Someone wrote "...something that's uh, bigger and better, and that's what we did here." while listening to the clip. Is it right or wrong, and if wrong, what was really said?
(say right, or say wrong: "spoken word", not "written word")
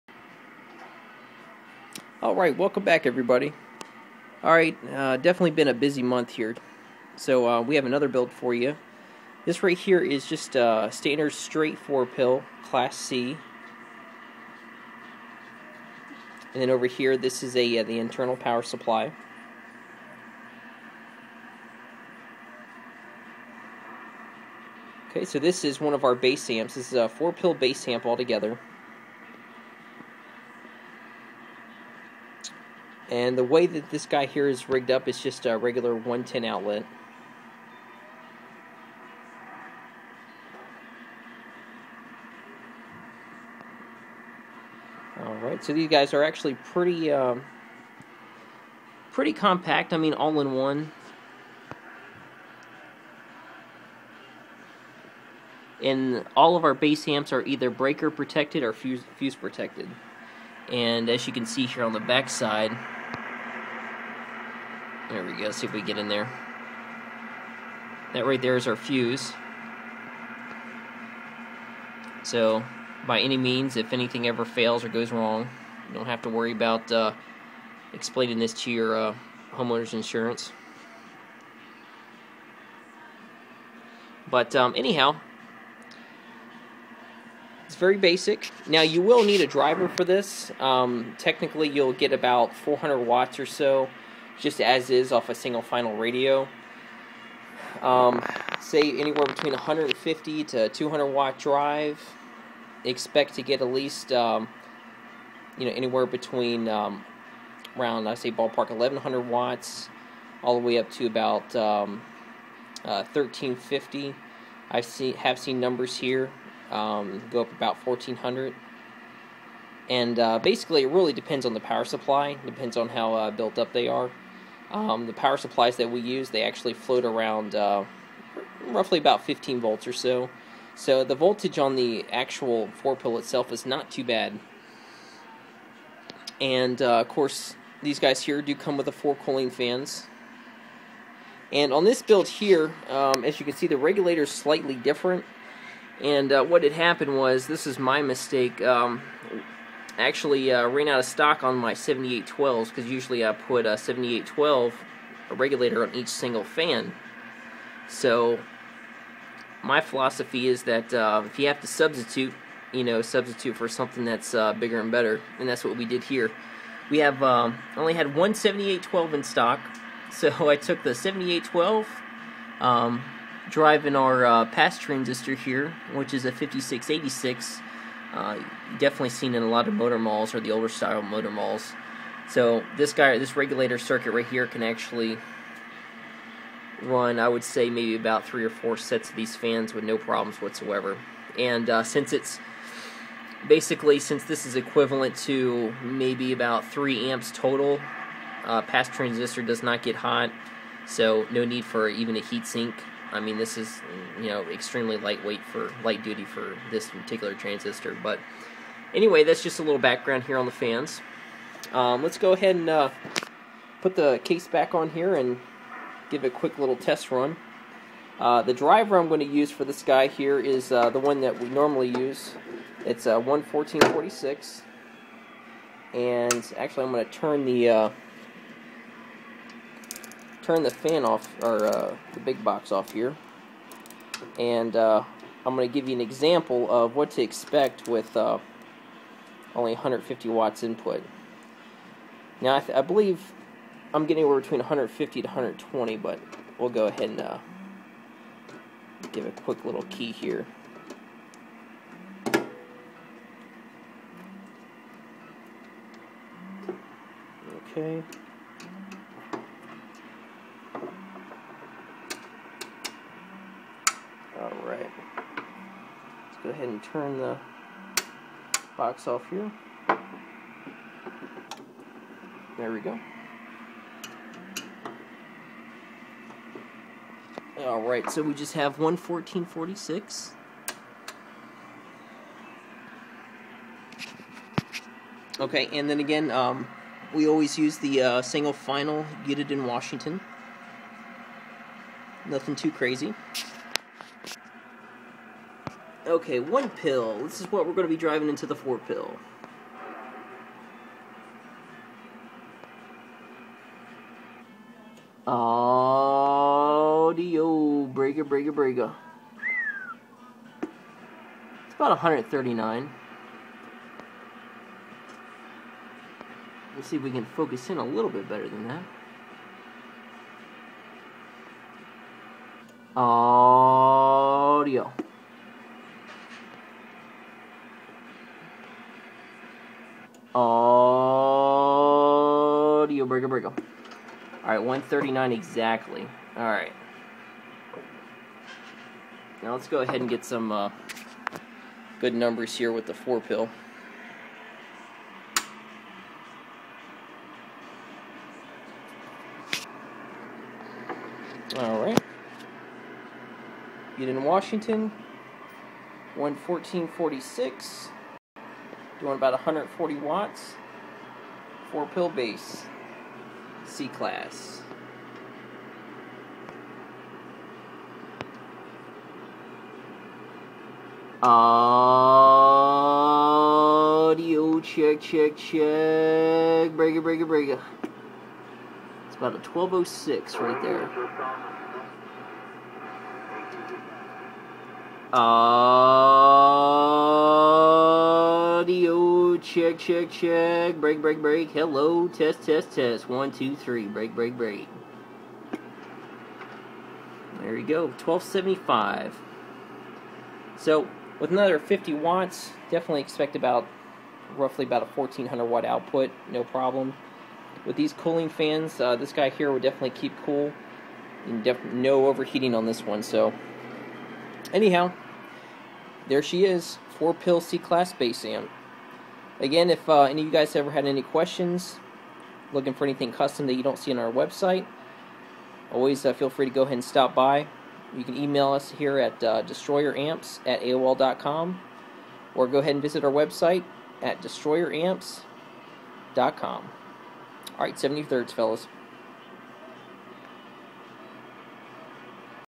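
right.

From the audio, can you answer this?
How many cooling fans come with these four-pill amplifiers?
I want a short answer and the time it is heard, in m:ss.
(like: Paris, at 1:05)
4, at 2:18.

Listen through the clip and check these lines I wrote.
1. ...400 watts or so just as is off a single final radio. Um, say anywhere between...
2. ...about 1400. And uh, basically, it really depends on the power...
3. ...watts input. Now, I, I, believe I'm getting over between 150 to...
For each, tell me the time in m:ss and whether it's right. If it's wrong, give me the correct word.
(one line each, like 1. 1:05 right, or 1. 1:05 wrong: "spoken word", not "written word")
1. 1:32 right
2. 1:57 right
3. 4:00 right.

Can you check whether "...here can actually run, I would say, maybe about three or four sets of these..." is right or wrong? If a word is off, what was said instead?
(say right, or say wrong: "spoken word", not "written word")
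right.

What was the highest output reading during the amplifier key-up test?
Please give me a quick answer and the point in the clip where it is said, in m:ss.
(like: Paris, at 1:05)
1275, at 6:37.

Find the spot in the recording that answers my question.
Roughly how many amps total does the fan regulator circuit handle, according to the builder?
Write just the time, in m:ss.
3:16.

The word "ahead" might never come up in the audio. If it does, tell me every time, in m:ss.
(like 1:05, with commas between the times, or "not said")
3:32, 4:06, 4:26, 5:39, 7:06, 7:12.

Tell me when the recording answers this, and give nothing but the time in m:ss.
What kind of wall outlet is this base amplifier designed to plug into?
0:35.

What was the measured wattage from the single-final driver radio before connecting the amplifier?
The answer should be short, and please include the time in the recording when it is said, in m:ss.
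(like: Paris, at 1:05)
139, at 5:34.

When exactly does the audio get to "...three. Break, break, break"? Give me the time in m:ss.
6:33.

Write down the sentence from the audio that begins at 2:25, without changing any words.
And uh, what had happened was, this is my mistake.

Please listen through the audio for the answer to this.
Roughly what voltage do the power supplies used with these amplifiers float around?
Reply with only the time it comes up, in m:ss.
2:09.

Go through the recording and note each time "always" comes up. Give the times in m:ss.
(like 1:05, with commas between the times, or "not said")
4:47, 7:05.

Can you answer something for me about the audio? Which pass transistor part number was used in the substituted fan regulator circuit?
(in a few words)
5686.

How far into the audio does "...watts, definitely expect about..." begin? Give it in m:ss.
6:41.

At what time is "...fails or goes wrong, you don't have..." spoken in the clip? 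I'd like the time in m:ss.
1:14.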